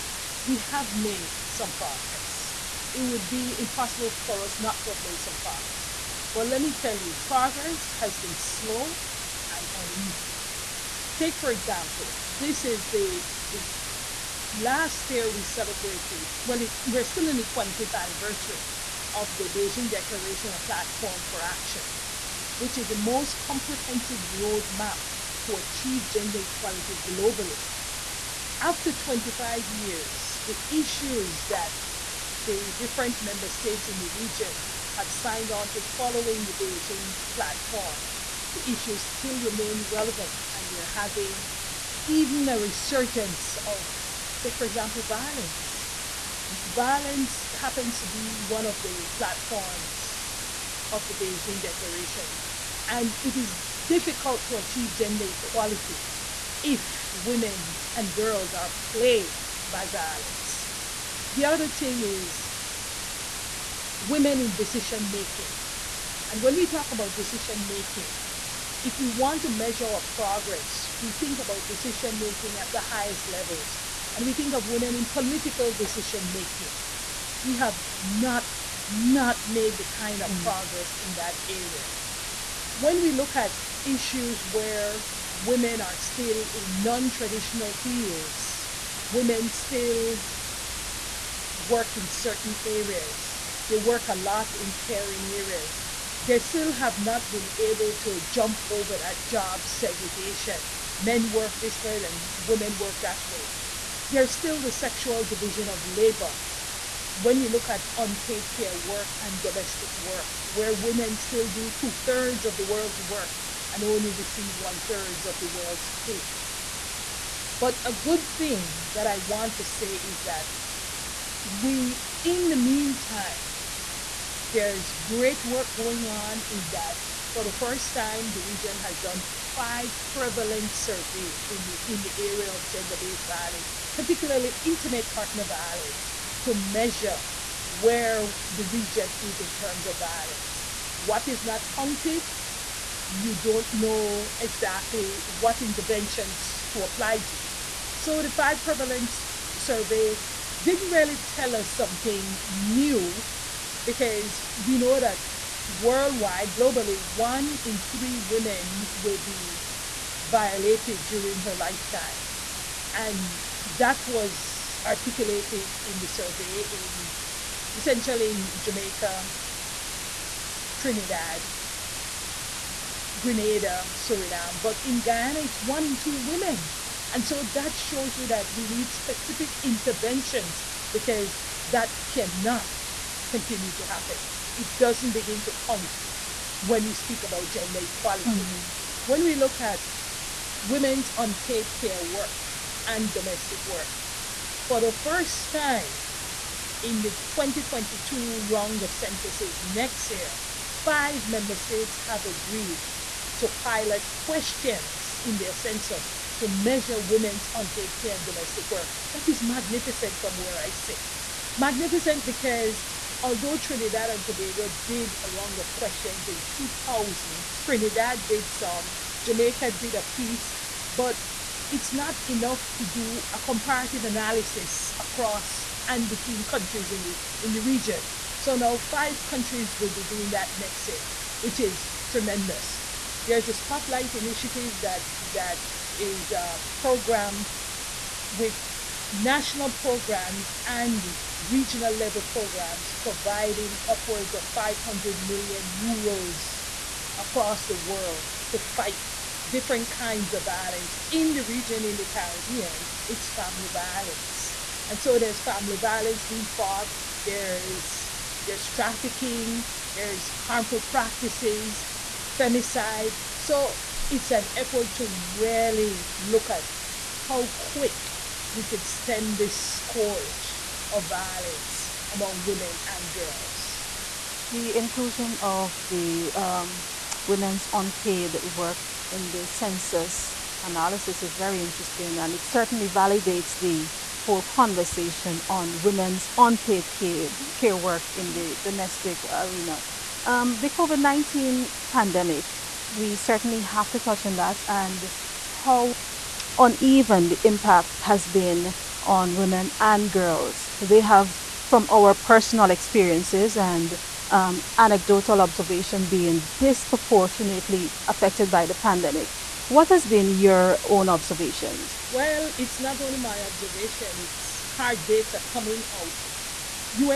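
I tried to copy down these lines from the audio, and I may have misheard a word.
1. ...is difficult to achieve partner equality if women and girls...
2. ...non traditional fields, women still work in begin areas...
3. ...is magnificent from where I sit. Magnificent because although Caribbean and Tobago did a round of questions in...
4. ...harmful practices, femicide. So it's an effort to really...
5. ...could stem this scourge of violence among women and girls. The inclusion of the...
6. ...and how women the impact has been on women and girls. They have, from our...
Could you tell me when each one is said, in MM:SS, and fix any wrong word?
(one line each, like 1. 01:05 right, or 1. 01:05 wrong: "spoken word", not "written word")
1. 00:53 wrong: "gender", not "partner"
2. 01:26 wrong: "certain", not "begin"
3. 03:29 wrong: "Trinidad", not "Caribbean"
4. 04:20 right
5. 04:28 right
6. 04:54 wrong: "uneven", not "women".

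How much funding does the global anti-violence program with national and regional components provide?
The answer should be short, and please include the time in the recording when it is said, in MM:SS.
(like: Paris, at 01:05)
500 million euros, at 04:04.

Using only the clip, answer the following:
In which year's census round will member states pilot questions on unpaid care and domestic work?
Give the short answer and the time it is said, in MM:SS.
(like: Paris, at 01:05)
2022, at 03:17.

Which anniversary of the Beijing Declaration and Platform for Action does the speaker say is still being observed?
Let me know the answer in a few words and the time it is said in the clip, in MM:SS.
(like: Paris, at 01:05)
25th, at 00:17.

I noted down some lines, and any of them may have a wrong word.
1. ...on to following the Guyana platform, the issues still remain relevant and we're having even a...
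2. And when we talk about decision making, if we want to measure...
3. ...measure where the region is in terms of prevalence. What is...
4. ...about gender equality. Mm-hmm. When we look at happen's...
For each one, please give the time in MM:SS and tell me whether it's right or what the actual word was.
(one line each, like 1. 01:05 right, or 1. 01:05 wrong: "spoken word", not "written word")
1. 00:35 wrong: "Beijing", not "Guyana"
2. 01:06 right
3. 02:16 wrong: "violence", not "prevalence"
4. 03:07 wrong: "women", not "happen".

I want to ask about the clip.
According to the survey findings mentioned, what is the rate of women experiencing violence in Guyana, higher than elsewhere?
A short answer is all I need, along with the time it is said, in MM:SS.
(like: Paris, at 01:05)
one in two women, at 02:55.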